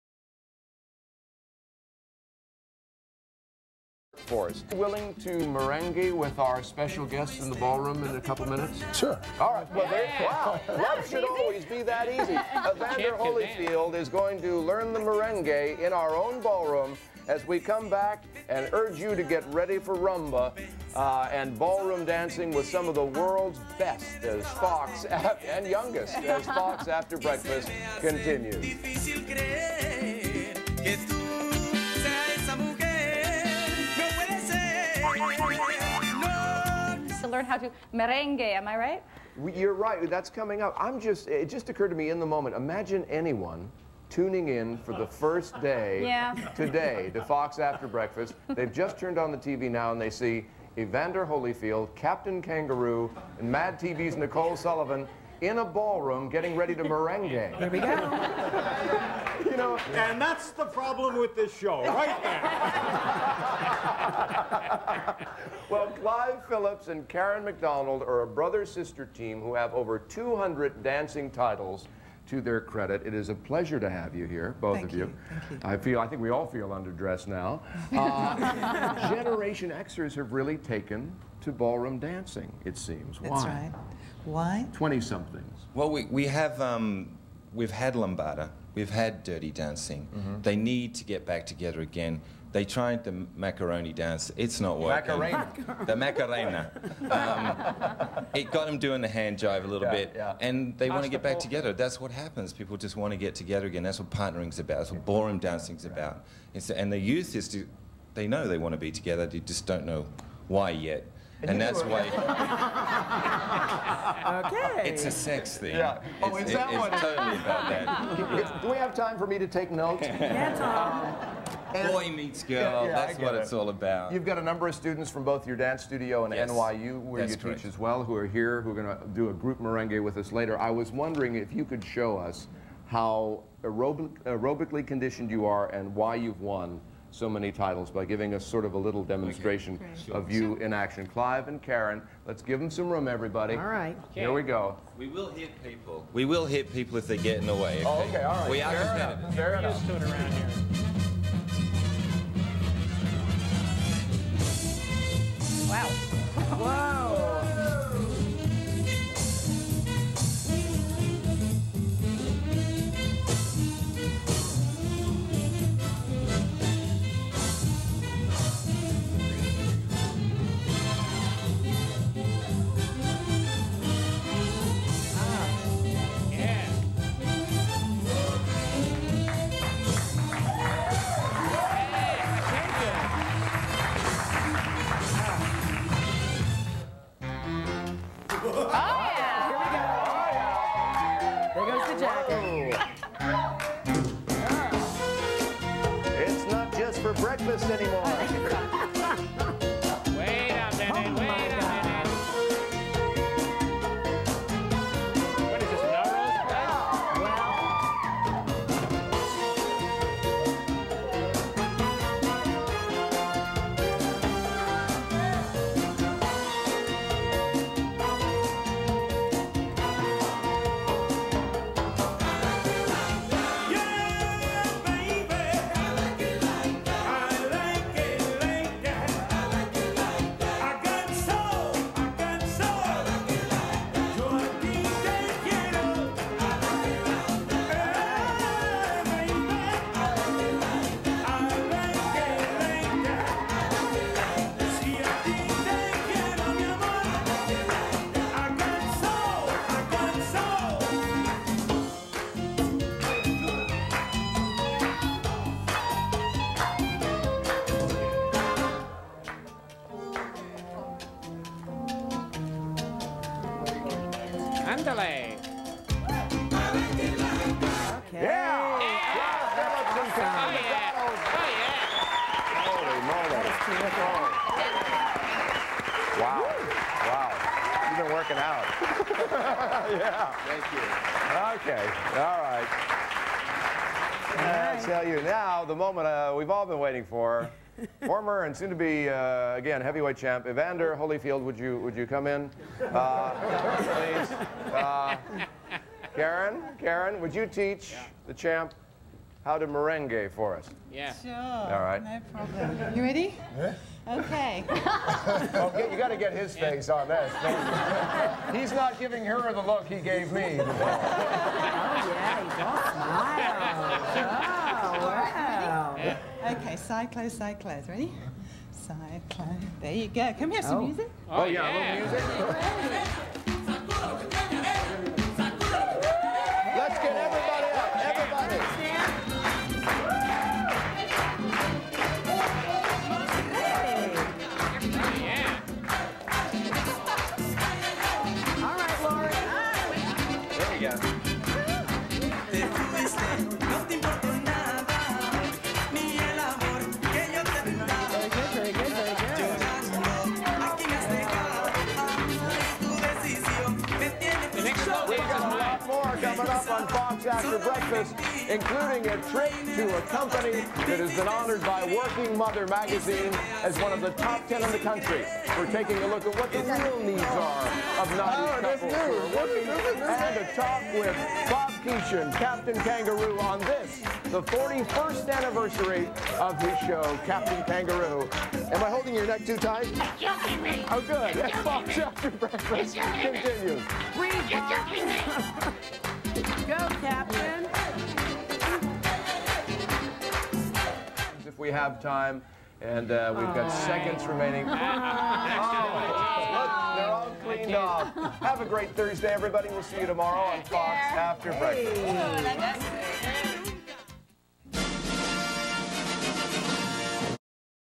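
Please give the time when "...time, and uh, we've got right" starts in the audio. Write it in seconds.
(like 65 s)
392 s.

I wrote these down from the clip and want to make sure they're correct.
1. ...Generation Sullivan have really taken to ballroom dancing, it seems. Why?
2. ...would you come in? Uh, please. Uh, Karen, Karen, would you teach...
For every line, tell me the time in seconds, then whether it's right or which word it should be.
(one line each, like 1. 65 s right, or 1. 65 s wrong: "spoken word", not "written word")
1. 79 s wrong: "Xers", not "Sullivan"
2. 291 s right.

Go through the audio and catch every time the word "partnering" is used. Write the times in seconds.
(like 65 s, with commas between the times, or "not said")
104 s.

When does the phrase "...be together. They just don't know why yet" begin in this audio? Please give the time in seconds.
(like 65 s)
108 s.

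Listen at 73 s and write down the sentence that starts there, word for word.
It is a pleasure to have you here, both Thank of you.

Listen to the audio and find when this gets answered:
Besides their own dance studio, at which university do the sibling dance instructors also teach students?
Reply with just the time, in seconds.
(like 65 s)
126 s.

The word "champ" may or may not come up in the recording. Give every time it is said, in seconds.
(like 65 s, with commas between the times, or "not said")
290 s, 298 s.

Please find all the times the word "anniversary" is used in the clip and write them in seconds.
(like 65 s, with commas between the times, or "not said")
375 s.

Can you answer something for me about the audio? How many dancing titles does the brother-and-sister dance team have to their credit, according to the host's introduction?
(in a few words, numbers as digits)
over 200.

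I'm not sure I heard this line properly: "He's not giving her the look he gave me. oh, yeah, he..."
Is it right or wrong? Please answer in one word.
right.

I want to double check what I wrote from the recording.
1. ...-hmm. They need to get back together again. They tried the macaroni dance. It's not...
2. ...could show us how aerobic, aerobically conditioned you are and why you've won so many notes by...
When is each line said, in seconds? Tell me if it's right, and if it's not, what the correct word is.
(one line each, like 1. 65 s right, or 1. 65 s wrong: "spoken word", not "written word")
1. 90 s right
2. 131 s wrong: "titles", not "notes".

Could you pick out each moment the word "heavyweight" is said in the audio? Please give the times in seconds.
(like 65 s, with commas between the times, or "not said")
289 s.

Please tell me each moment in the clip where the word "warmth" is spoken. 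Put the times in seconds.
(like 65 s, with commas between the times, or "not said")
not said.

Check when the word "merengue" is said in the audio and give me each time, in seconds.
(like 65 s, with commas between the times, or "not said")
5 s, 14 s, 37 s, 56 s, 129 s, 299 s.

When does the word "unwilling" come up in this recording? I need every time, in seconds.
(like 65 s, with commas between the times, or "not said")
not said.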